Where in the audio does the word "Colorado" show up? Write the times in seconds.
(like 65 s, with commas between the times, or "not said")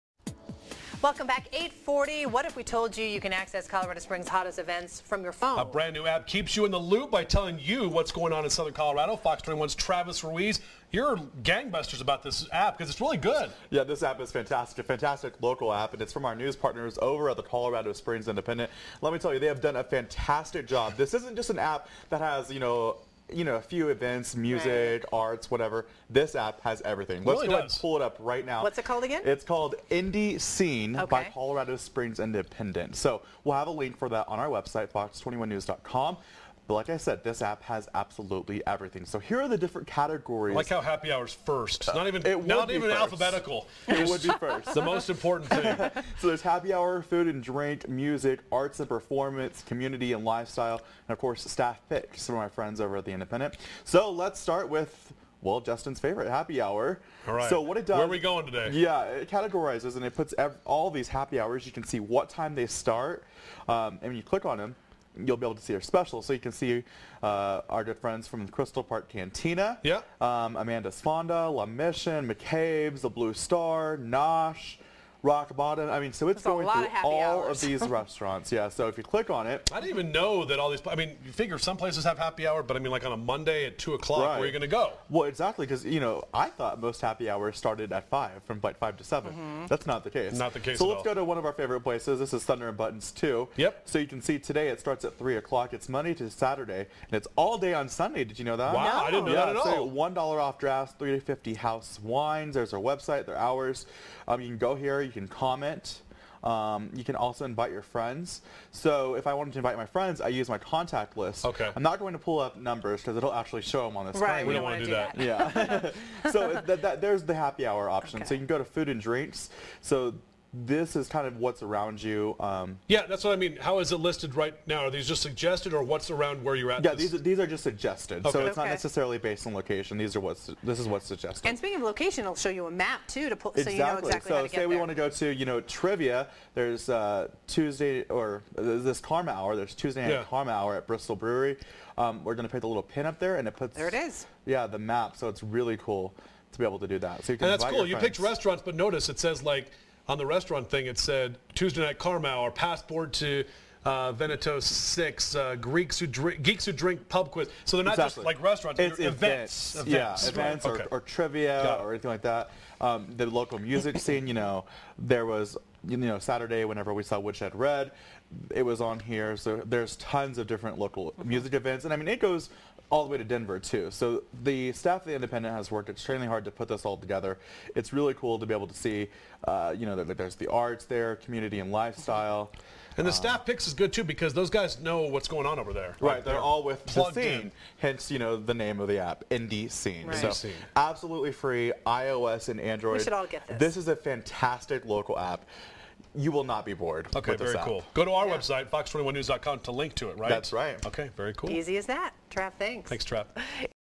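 3 s, 8 s, 17 s, 31 s.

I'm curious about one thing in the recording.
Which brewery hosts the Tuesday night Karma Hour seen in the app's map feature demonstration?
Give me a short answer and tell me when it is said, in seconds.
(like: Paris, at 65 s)
Bristol Brewery, at 140 s.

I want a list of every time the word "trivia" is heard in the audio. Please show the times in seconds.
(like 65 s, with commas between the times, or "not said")
135 s, 161 s.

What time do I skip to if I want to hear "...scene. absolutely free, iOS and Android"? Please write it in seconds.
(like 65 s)
190 s.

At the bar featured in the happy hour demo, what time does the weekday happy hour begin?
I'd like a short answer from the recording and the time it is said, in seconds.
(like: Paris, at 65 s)
3 o'clock, at 95 s.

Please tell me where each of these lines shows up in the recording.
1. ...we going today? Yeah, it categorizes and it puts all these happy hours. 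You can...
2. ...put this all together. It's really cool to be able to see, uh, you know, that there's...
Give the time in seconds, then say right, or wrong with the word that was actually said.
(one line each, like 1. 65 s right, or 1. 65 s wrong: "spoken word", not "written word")
1. 58 s right
2. 176 s right.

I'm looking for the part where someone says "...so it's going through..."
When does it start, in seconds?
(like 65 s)
76 s.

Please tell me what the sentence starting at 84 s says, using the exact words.
where are you going to go?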